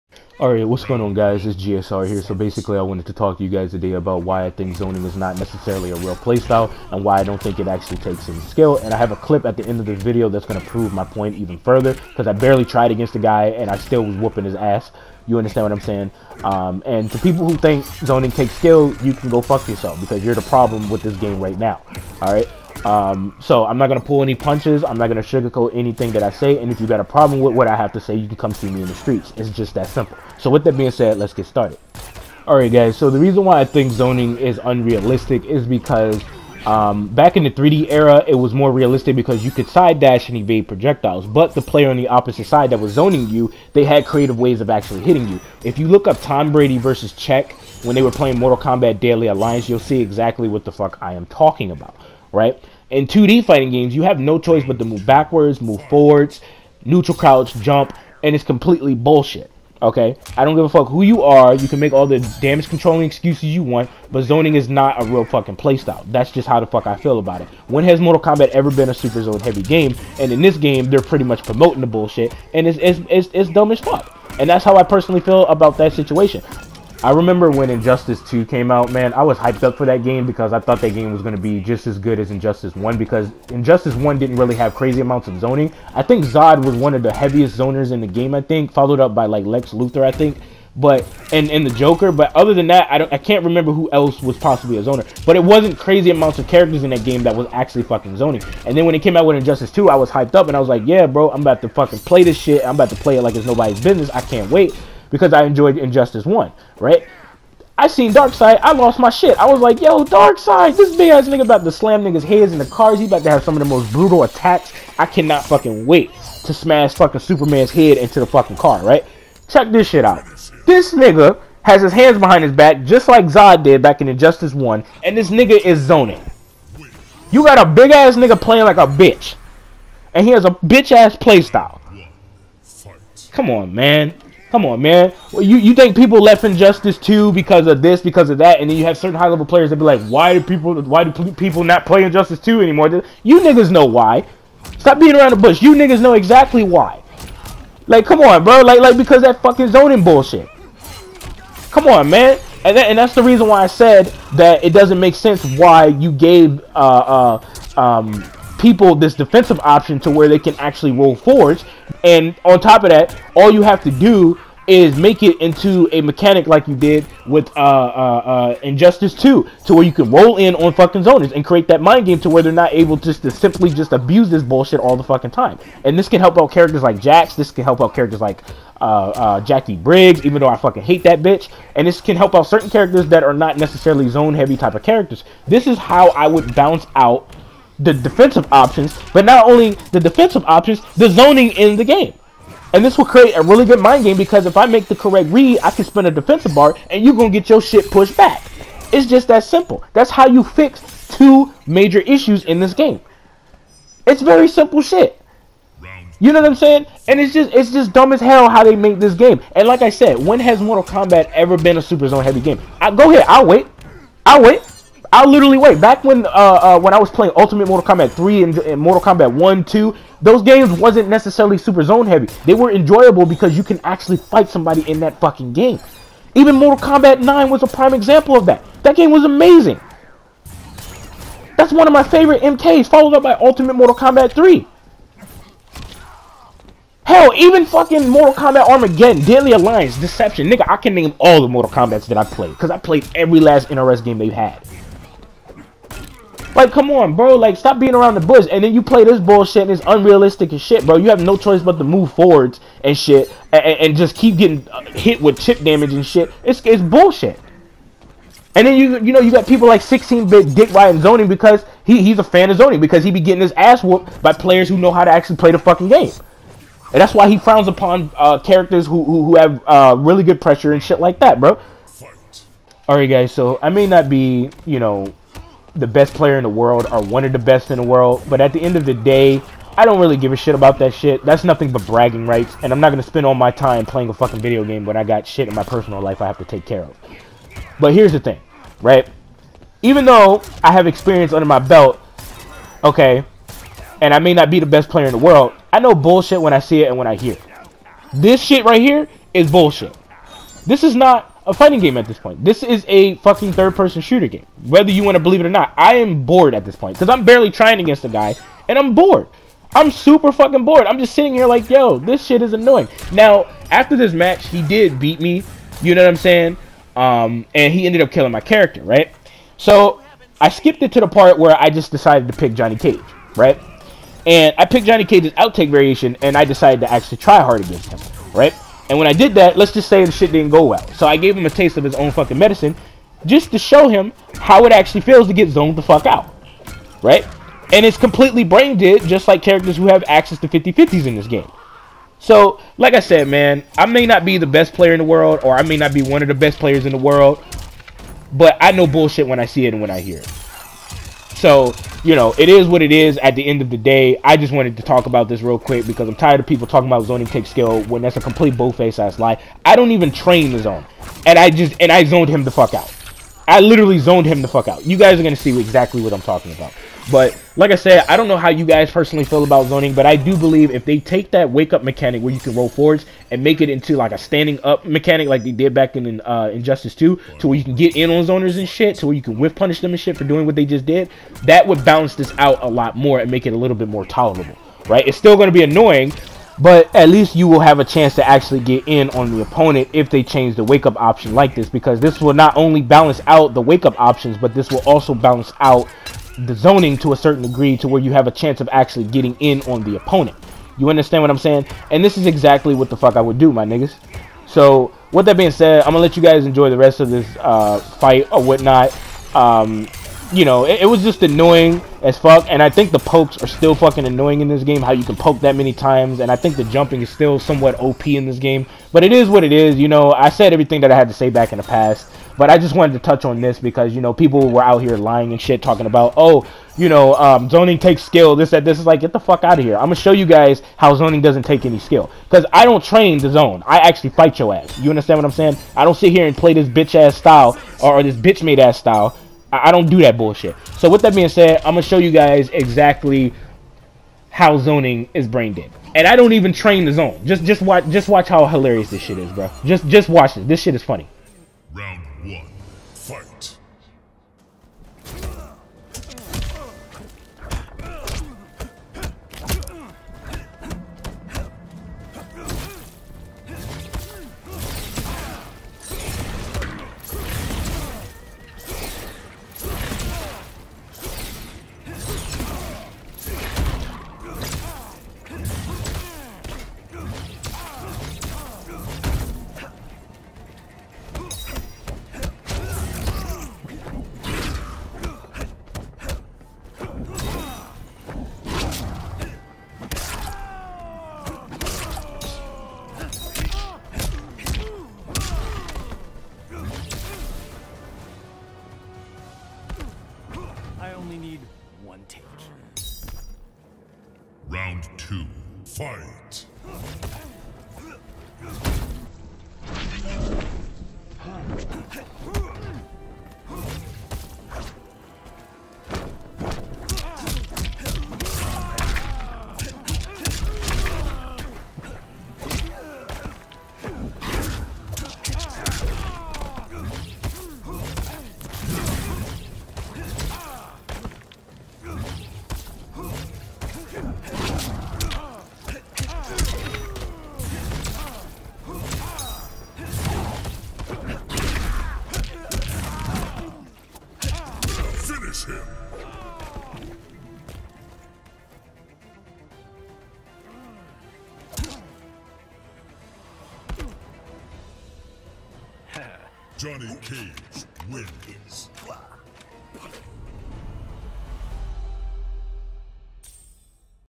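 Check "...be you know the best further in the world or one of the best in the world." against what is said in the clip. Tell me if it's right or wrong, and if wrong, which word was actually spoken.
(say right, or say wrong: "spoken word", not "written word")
wrong: "player", not "further".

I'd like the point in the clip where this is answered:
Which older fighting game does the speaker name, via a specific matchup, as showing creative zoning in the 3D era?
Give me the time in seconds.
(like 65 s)
48 s.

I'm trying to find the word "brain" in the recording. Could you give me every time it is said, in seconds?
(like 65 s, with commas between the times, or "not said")
338 s, 445 s.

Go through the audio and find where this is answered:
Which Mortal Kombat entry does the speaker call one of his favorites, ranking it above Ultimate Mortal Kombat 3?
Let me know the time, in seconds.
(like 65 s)
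226 s.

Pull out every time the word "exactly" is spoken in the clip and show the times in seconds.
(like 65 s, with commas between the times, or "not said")
50 s, 146 s, 365 s, 402 s, 442 s.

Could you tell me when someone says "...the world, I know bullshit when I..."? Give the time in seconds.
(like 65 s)
295 s.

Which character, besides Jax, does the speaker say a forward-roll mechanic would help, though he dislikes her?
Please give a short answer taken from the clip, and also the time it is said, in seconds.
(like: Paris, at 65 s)
Jacqui Briggs, at 179 s.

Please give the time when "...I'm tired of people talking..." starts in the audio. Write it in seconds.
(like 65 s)
356 s.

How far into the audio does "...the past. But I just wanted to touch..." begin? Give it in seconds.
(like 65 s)
421 s.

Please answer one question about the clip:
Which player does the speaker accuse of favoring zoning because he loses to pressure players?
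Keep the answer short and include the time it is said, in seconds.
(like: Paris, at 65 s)
16-bit Dick Ryan, at 259 s.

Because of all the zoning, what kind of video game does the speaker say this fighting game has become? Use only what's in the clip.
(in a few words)
third-person shooter.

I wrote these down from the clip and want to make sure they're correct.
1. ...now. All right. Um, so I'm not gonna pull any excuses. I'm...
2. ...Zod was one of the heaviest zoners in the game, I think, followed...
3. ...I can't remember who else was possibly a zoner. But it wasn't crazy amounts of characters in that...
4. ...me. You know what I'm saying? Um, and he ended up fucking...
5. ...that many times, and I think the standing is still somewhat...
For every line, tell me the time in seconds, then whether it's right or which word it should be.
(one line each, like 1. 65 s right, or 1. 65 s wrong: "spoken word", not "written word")
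1. 21 s wrong: "punches", not "excuses"
2. 86 s right
3. 93 s right
4. 315 s wrong: "killing", not "fucking"
5. 415 s wrong: "jumping", not "standing".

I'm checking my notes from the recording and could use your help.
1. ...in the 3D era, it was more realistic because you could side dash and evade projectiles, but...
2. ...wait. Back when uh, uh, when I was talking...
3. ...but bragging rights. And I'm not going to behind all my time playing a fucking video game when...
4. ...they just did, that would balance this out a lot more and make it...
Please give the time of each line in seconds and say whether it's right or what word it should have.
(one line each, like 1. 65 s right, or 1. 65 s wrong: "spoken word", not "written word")
1. 37 s right
2. 215 s wrong: "playing", not "talking"
3. 281 s wrong: "spend", not "behind"
4. 380 s right.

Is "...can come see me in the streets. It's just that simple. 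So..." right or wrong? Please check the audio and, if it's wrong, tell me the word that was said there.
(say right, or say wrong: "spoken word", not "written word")
right.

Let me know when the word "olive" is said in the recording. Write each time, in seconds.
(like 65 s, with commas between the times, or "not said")
not said.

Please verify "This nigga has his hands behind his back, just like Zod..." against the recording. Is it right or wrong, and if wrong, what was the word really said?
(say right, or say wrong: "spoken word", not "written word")
right.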